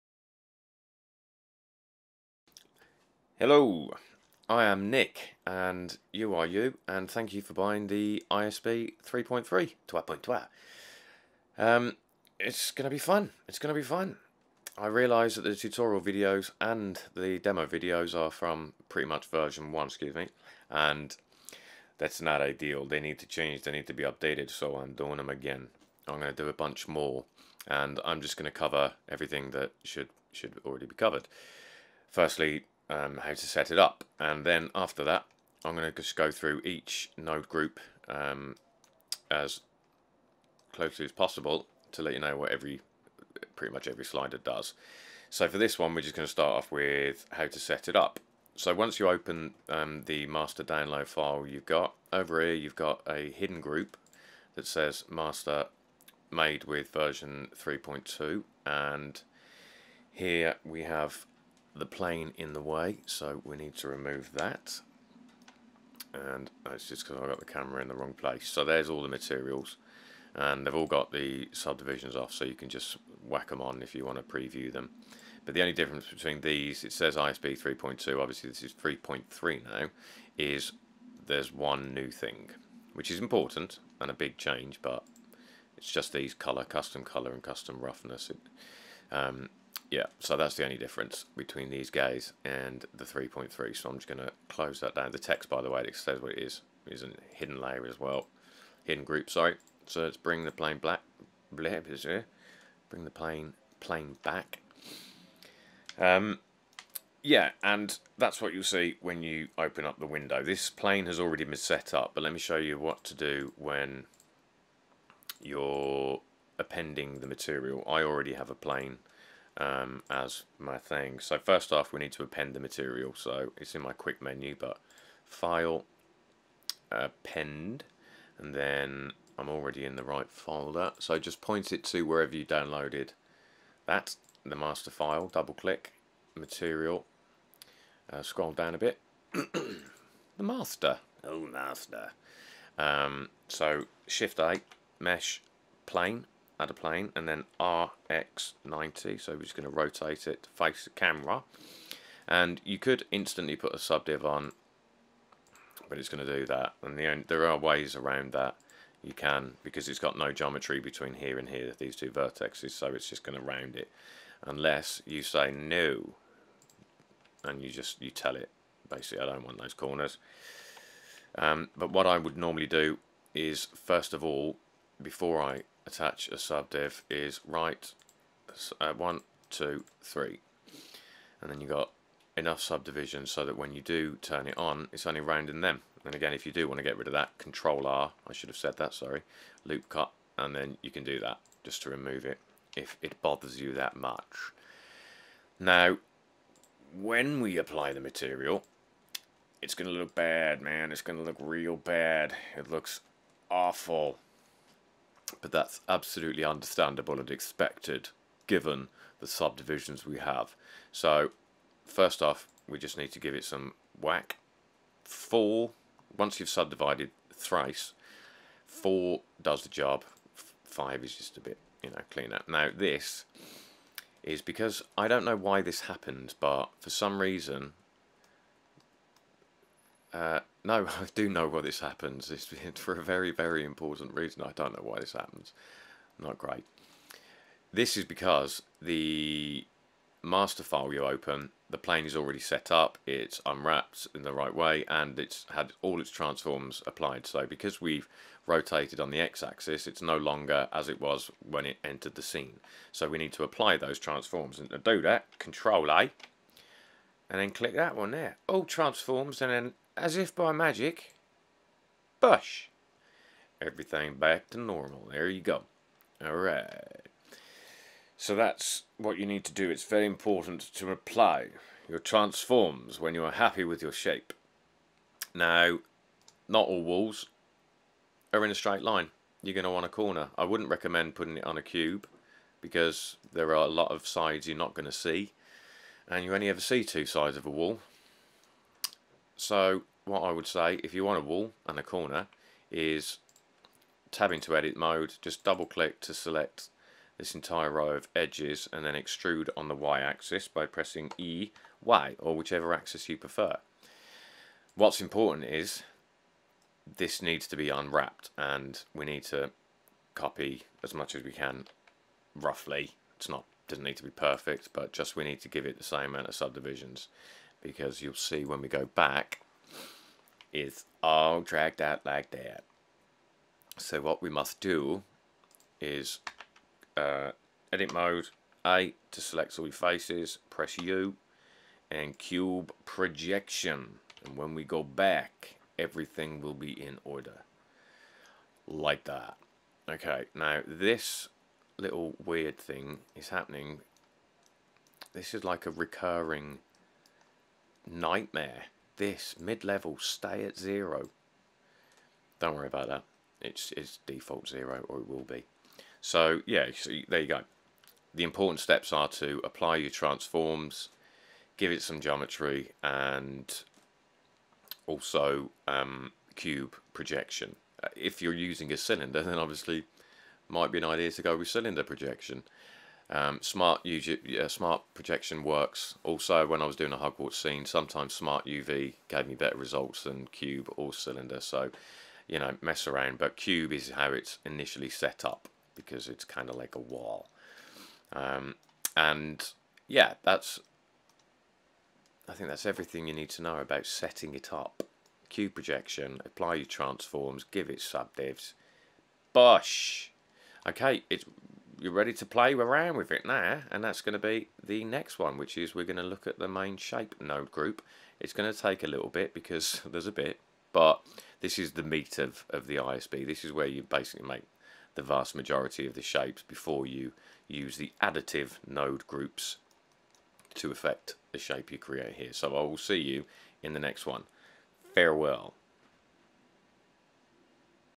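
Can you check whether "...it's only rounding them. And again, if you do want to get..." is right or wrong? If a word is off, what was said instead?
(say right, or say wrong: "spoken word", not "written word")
right.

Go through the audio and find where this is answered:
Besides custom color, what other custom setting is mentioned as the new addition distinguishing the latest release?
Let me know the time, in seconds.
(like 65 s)
87 s.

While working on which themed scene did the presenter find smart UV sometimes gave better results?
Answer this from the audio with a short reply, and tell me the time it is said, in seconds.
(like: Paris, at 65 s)
Hogwarts, at 376 s.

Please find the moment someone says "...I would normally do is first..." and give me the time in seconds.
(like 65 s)
172 s.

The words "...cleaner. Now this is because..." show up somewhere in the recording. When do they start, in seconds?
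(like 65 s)
222 s.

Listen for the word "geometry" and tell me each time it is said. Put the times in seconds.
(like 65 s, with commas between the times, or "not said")
160 s, 362 s.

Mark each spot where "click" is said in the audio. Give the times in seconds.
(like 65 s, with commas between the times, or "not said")
135 s, 257 s, 295 s.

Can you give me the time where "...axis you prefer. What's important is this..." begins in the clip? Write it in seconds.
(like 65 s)
302 s.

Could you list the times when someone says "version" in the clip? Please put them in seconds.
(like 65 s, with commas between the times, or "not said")
19 s, 56 s.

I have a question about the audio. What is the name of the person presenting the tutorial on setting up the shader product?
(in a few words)
Nick.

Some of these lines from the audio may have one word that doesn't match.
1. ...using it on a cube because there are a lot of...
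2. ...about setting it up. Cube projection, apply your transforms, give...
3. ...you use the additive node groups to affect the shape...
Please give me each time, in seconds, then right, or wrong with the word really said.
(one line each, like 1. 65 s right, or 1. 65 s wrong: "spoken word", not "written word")
1. 281 s wrong: "putting", not "using"
2. 393 s right
3. 416 s right.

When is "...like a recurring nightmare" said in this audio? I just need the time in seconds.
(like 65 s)
345 s.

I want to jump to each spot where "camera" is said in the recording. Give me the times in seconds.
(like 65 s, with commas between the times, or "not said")
67 s, 150 s.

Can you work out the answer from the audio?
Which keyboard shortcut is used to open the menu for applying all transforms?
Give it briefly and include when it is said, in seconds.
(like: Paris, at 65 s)
Control-A, at 255 s.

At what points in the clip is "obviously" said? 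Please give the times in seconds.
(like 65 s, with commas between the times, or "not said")
78 s, 369 s.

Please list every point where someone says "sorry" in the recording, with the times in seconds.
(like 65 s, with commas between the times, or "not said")
99 s, 188 s.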